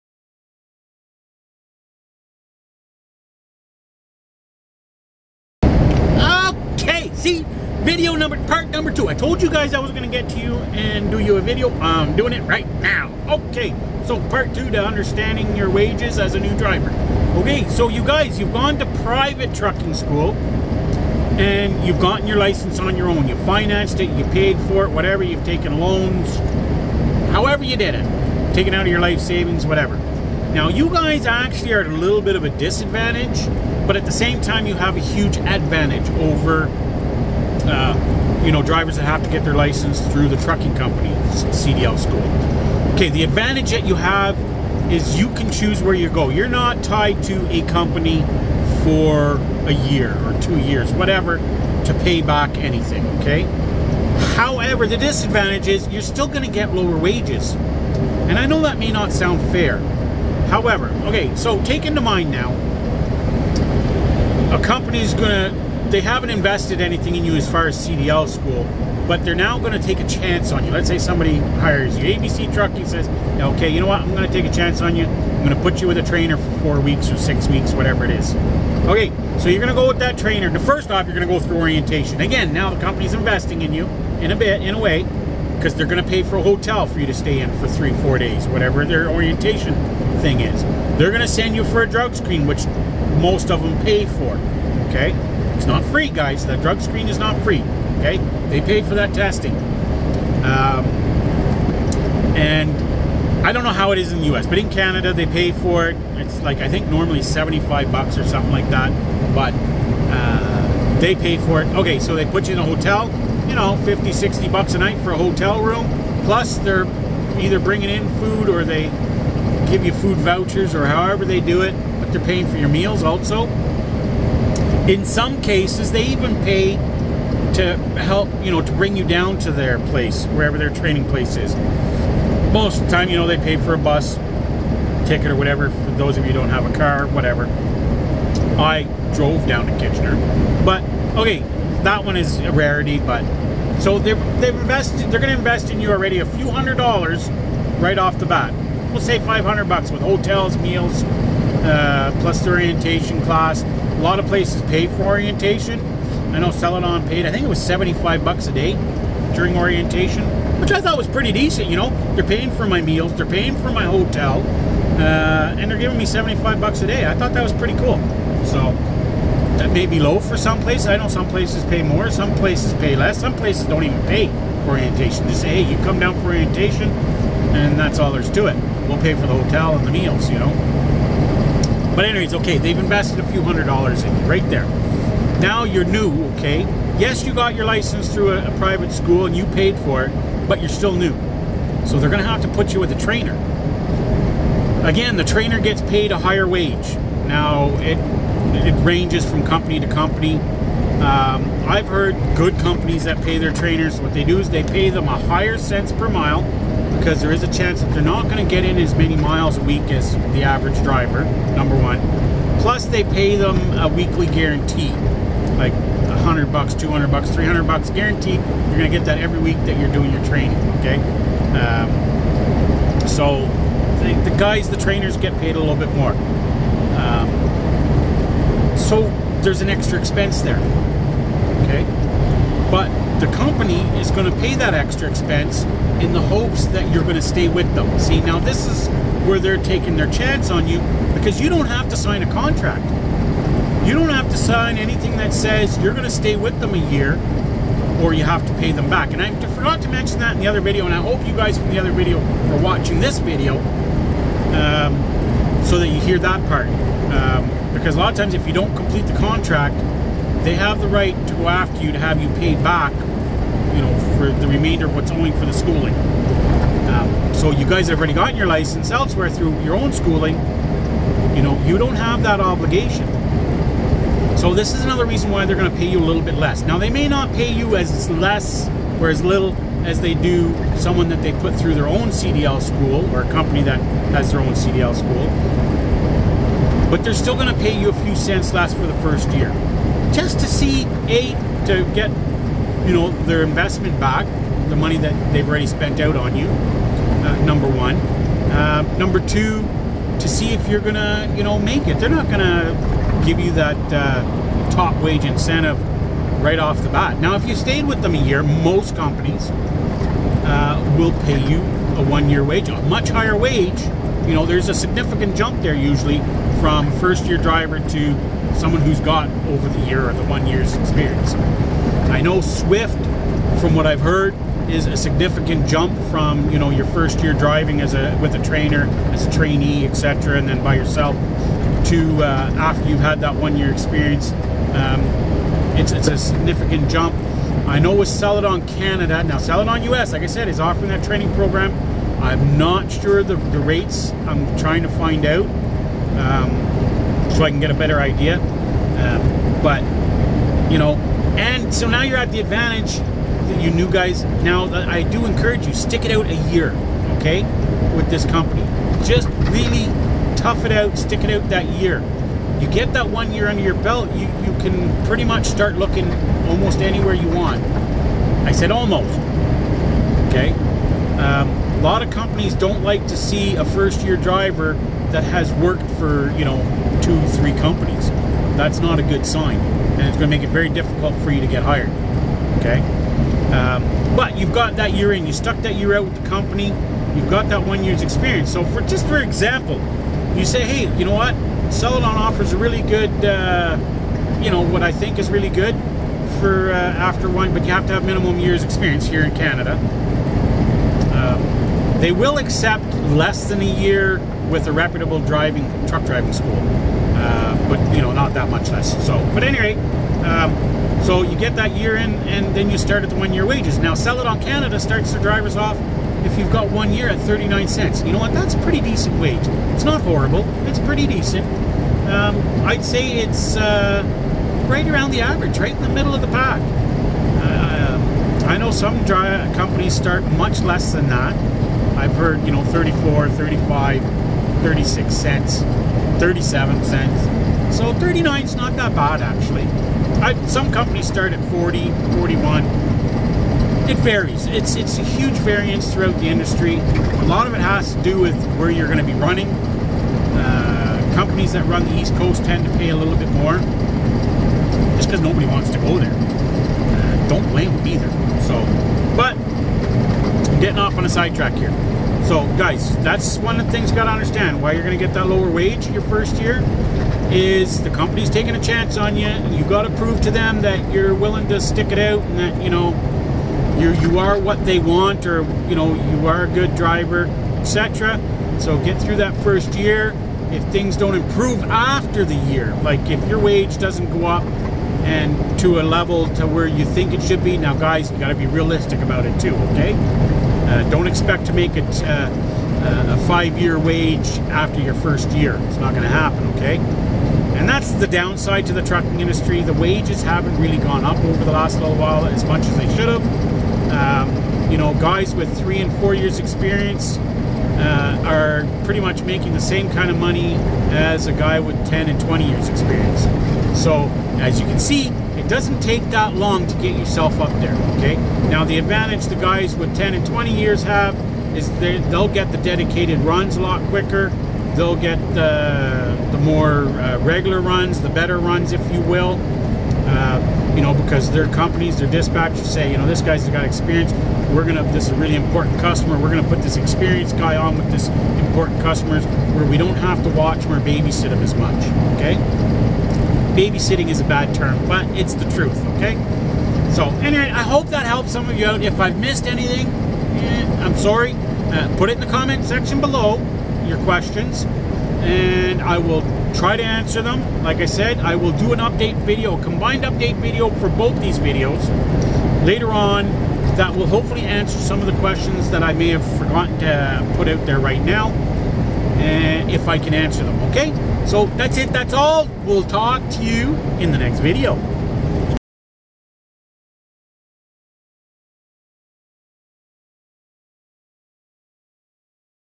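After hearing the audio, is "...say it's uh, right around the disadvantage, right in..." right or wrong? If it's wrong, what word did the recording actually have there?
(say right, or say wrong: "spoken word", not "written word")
wrong: "average", not "disadvantage".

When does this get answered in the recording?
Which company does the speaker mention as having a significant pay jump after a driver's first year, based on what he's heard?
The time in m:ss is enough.
5:22.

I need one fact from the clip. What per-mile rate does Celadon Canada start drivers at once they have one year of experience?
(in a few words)
39 cents.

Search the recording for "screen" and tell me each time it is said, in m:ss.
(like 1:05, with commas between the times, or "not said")
1:32, 1:36.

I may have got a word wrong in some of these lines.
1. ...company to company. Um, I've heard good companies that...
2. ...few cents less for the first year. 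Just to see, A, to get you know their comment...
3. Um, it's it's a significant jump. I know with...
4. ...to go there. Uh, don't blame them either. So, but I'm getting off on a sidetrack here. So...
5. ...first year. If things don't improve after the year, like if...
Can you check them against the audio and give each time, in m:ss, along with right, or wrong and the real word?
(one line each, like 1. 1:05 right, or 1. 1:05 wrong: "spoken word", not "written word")
1. 3:19 right
2. 4:48 wrong: "investment", not "comment"
3. 5:34 right
4. 7:35 right
5. 7:59 right.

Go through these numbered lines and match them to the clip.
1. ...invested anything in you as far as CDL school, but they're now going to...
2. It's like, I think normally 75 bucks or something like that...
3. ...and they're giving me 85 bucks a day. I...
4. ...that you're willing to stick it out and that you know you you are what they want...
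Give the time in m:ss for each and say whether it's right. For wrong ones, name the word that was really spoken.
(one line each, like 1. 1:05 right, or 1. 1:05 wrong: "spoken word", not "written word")
1. 1:06 right
2. 1:46 right
3. 2:45 wrong: "75", not "85"
4. 7:50 right.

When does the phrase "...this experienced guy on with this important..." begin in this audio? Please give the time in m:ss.
8:56.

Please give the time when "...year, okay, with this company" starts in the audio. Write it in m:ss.
5:56.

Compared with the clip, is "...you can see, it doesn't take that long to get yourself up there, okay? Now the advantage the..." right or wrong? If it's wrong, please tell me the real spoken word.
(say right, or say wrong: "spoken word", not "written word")
right.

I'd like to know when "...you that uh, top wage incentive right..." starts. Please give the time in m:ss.
5:03.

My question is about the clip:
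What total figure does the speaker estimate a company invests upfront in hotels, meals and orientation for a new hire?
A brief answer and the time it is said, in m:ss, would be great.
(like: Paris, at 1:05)
$500, at 2:29.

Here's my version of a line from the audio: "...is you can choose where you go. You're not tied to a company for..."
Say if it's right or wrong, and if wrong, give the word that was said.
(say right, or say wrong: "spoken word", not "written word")
right.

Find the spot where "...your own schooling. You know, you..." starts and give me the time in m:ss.
4:29.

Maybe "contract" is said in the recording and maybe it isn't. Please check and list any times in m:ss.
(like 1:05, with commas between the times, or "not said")
4:02, 4:19.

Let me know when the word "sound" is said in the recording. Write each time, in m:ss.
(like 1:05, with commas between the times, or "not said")
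0:59.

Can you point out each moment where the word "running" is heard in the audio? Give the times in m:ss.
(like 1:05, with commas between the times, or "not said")
7:29.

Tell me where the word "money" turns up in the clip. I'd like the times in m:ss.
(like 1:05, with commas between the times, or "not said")
4:54, 8:30.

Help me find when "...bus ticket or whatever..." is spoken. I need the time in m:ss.
2:13.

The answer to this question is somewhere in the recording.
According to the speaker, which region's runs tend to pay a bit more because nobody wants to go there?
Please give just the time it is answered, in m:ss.
7:31.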